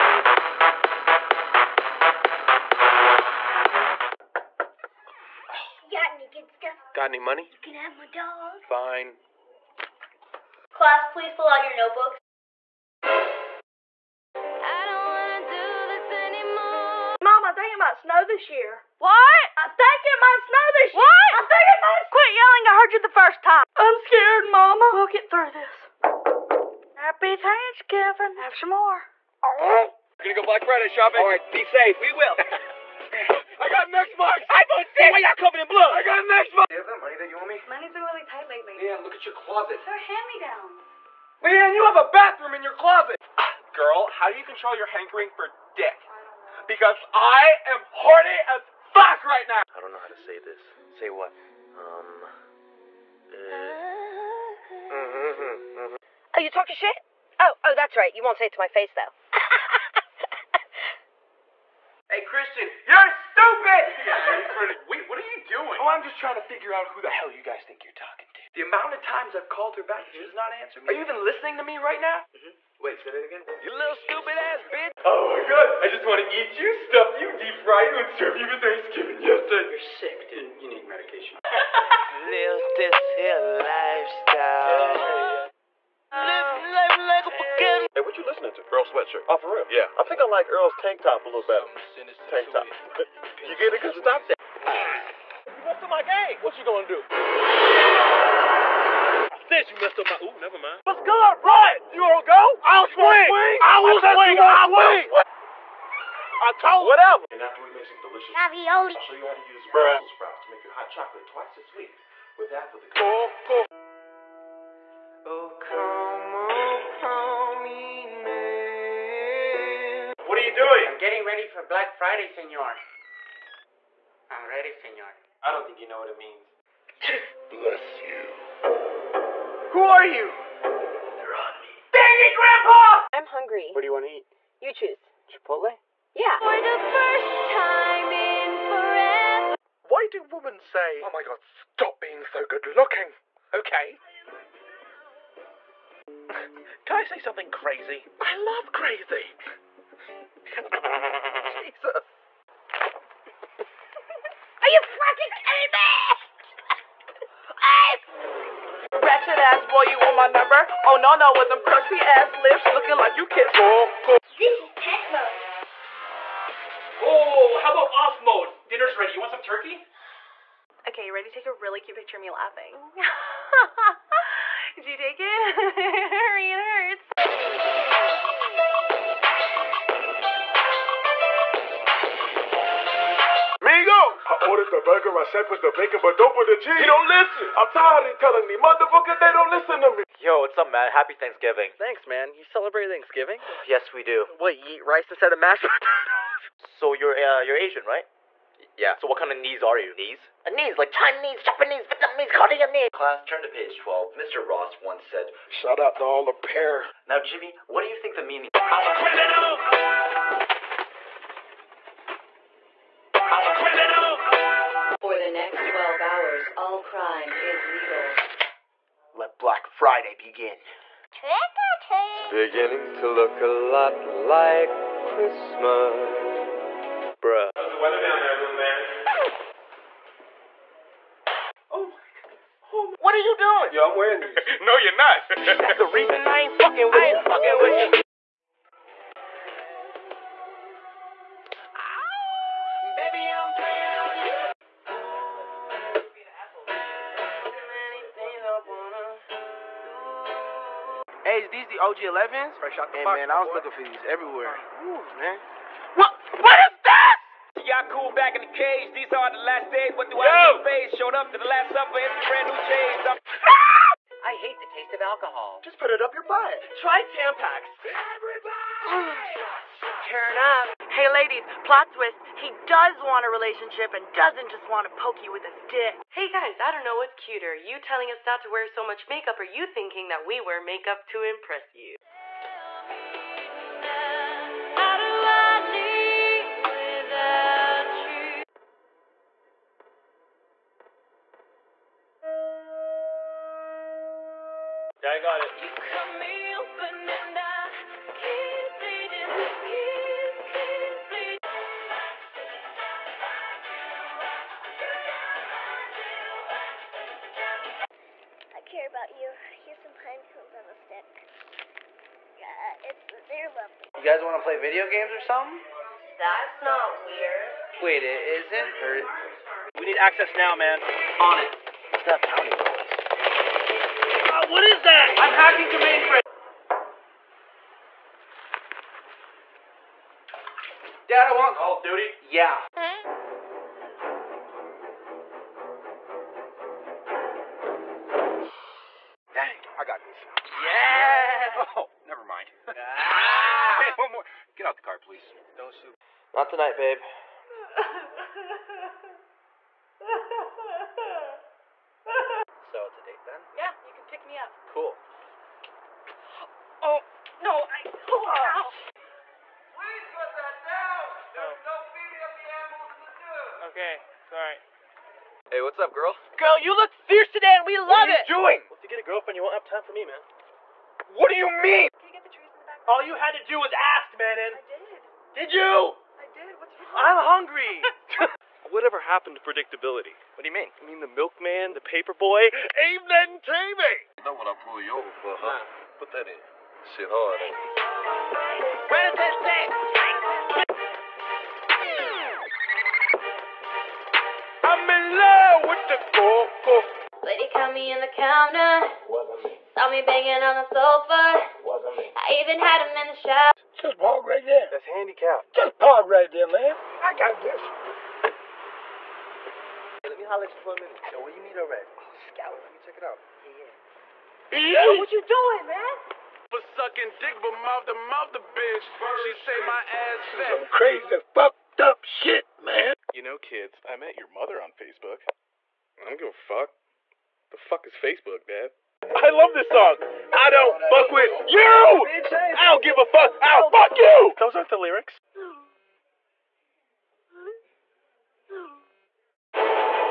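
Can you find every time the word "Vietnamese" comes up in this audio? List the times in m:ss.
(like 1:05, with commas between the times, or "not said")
3:21.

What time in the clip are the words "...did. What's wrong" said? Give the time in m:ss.
6:16.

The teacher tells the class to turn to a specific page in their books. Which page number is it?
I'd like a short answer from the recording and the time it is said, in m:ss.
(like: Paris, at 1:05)
12, at 3:23.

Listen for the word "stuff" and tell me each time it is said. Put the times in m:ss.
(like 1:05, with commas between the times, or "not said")
0:06, 1:16.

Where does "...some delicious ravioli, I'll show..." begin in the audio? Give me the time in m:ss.
1:47.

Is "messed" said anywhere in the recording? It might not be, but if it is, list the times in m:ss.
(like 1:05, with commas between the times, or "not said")
1:35, 1:39.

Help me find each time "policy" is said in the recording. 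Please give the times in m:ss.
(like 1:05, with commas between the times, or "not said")
not said.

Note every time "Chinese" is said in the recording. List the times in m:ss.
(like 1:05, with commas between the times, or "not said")
3:20.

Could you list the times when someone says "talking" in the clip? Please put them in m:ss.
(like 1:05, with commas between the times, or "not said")
0:56, 1:07.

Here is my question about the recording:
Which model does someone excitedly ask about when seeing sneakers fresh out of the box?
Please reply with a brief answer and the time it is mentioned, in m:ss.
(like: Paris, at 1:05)
OG 11s, at 4:11.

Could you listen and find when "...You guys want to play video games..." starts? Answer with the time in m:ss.
5:13.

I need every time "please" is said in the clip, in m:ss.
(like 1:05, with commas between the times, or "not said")
0:11, 5:44, 5:58.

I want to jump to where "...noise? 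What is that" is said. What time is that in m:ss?
5:22.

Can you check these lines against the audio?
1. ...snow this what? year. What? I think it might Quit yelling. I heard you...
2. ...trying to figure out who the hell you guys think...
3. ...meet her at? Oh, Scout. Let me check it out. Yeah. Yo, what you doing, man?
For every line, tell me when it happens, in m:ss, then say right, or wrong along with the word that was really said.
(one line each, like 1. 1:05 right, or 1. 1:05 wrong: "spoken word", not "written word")
1. 0:20 right
2. 1:06 right
3. 6:51 right.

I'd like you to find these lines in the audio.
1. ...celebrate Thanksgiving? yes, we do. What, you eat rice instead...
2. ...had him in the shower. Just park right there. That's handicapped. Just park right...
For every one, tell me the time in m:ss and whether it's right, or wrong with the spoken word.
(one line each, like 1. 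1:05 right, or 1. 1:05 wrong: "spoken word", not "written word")
1. 3:12 right
2. 6:42 right.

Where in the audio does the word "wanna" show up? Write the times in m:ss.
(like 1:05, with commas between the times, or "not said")
1:42.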